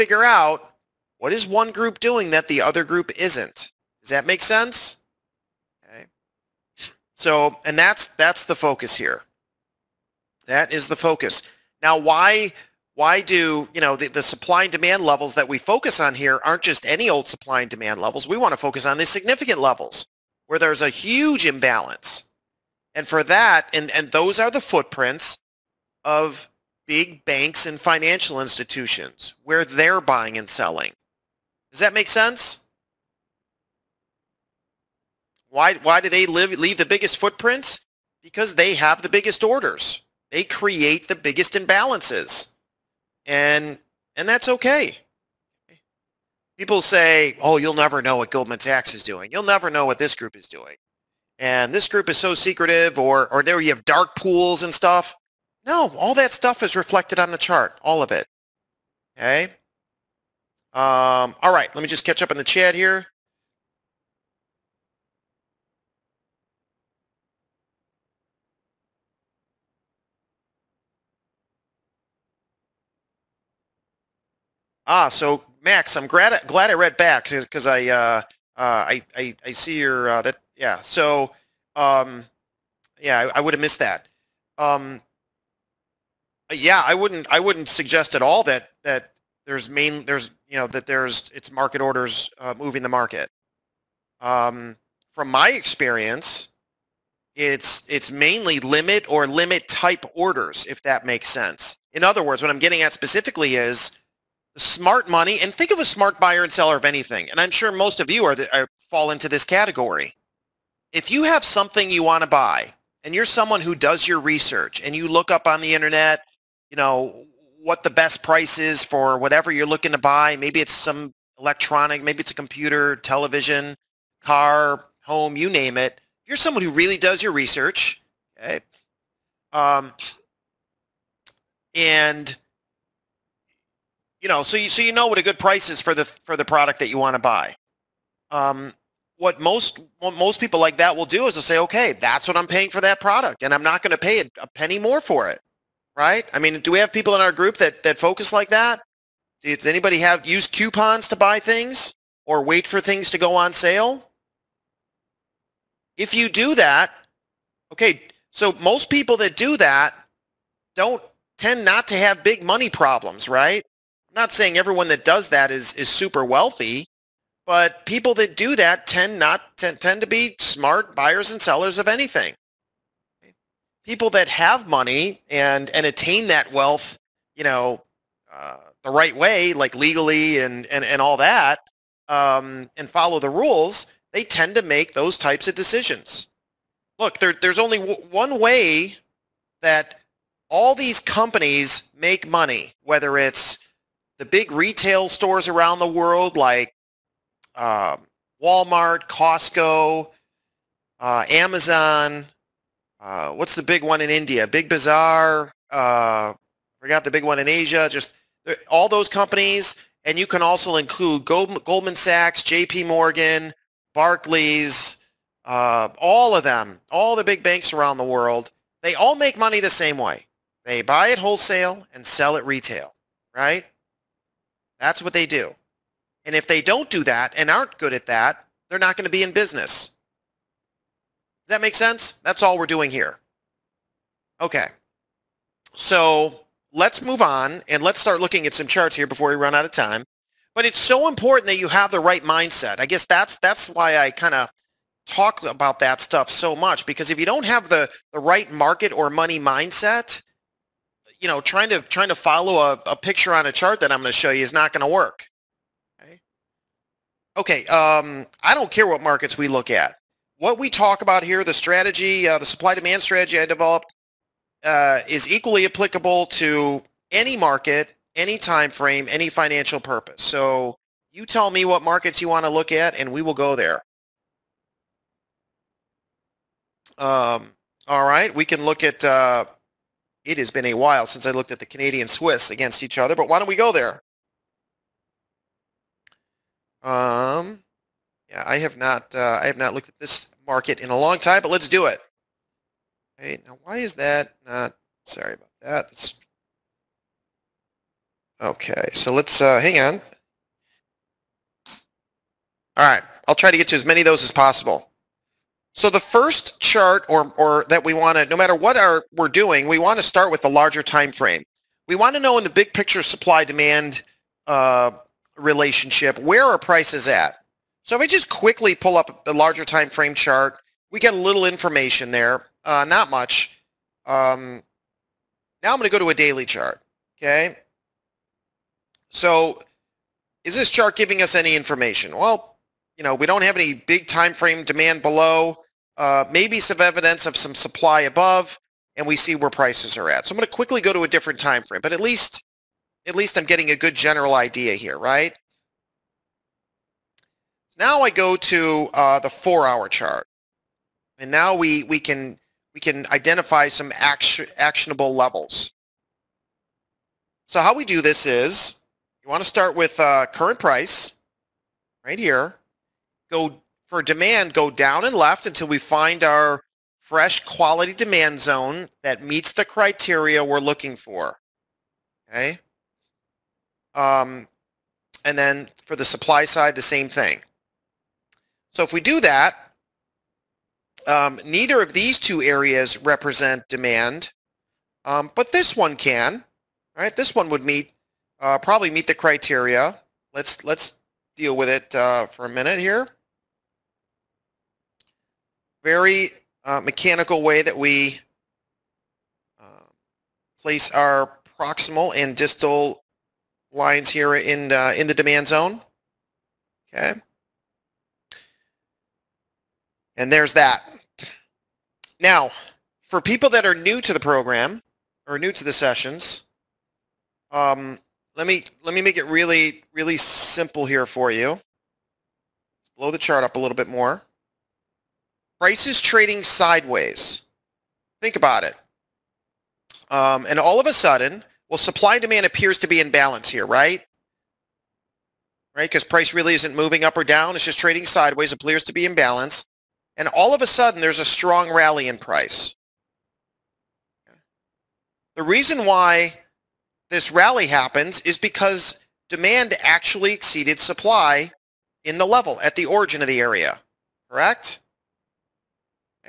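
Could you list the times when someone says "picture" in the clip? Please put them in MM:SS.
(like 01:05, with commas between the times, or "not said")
04:12, 05:12.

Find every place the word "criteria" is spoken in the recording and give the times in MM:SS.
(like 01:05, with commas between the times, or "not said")
06:09, 06:29.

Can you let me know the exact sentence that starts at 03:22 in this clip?
Uh, what's the big one in India?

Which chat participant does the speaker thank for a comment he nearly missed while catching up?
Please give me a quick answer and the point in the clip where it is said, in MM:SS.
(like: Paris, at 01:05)
Max, at 01:15.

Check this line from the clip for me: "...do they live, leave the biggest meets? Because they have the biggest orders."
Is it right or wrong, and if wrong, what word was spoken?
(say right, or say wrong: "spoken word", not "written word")
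wrong: "footprints", not "meets".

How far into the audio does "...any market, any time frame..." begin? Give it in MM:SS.
04:27.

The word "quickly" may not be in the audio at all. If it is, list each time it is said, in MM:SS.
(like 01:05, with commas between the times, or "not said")
05:18, 05:40.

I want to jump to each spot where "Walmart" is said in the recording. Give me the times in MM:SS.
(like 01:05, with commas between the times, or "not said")
03:18.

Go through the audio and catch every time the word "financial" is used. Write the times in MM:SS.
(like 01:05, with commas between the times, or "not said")
00:27, 04:29.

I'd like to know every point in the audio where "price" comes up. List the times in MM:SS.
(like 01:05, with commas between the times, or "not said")
01:58, 02:15, 05:16, 05:39, 06:00, 07:05, 07:16, 07:22.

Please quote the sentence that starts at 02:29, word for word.
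Does anybody have use coupons to buy things or wait for things to go on sale?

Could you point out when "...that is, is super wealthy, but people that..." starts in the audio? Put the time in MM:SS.
02:45.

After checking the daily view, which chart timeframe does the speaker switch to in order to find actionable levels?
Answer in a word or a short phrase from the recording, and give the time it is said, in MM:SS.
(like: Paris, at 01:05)
four-hour, at 05:49.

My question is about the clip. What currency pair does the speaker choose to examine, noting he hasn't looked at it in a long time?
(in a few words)
Canadian Swiss.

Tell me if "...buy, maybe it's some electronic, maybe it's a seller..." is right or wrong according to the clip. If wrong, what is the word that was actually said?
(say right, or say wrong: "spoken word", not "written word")
wrong: "computer", not "seller".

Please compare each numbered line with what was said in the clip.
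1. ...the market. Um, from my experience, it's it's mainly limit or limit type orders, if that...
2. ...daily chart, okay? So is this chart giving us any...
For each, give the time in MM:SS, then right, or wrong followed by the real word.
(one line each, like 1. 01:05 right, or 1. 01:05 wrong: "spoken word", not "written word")
1. 01:32 right
2. 05:26 right.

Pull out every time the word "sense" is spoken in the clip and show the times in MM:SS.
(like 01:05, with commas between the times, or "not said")
00:04, 00:32, 01:41, 03:51.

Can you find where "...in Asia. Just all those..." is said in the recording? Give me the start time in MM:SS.
03:27.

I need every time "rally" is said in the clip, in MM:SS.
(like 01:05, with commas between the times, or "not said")
07:21, 07:27.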